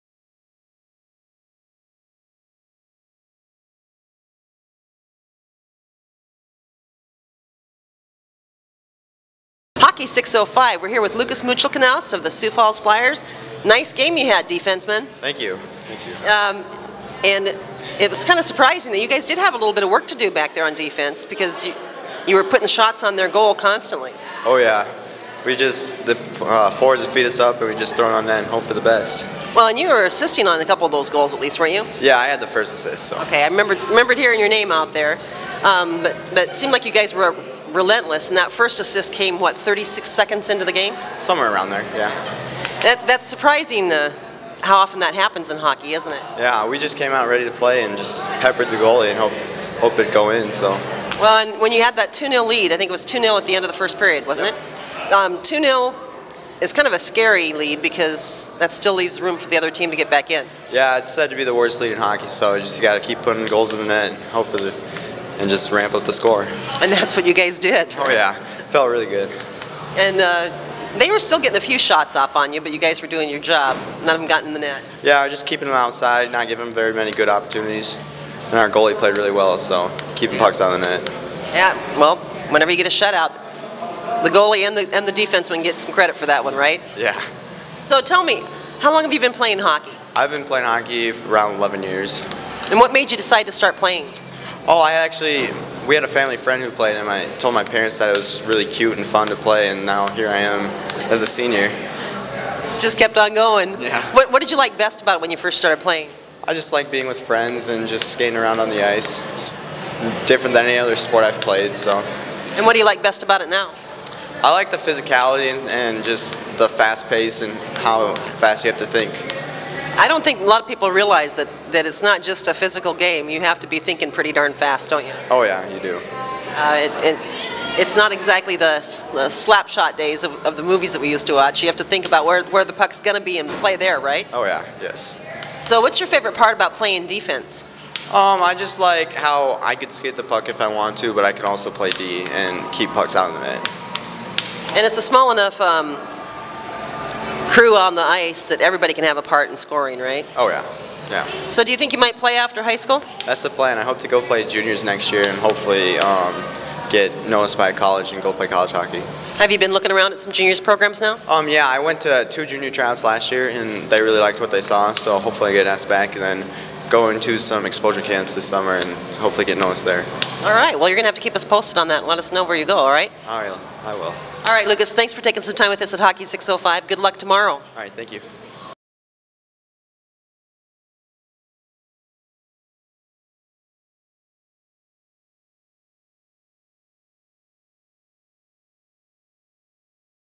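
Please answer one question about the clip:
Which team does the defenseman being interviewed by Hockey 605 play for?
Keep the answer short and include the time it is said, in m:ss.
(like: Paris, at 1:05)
Sioux Falls Flyers, at 0:12.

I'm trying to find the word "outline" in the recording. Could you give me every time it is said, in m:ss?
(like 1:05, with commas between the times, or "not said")
not said.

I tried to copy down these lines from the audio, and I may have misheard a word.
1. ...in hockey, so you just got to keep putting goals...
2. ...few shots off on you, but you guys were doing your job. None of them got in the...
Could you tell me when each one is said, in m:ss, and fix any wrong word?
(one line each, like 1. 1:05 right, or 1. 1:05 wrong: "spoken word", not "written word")
1. 1:01 right
2. 1:11 right.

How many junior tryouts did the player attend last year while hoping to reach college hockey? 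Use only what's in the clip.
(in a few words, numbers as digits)
2.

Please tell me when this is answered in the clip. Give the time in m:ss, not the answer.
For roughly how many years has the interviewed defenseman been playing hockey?
1:31.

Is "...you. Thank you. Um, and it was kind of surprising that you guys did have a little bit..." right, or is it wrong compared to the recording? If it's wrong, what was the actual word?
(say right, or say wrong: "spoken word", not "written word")
right.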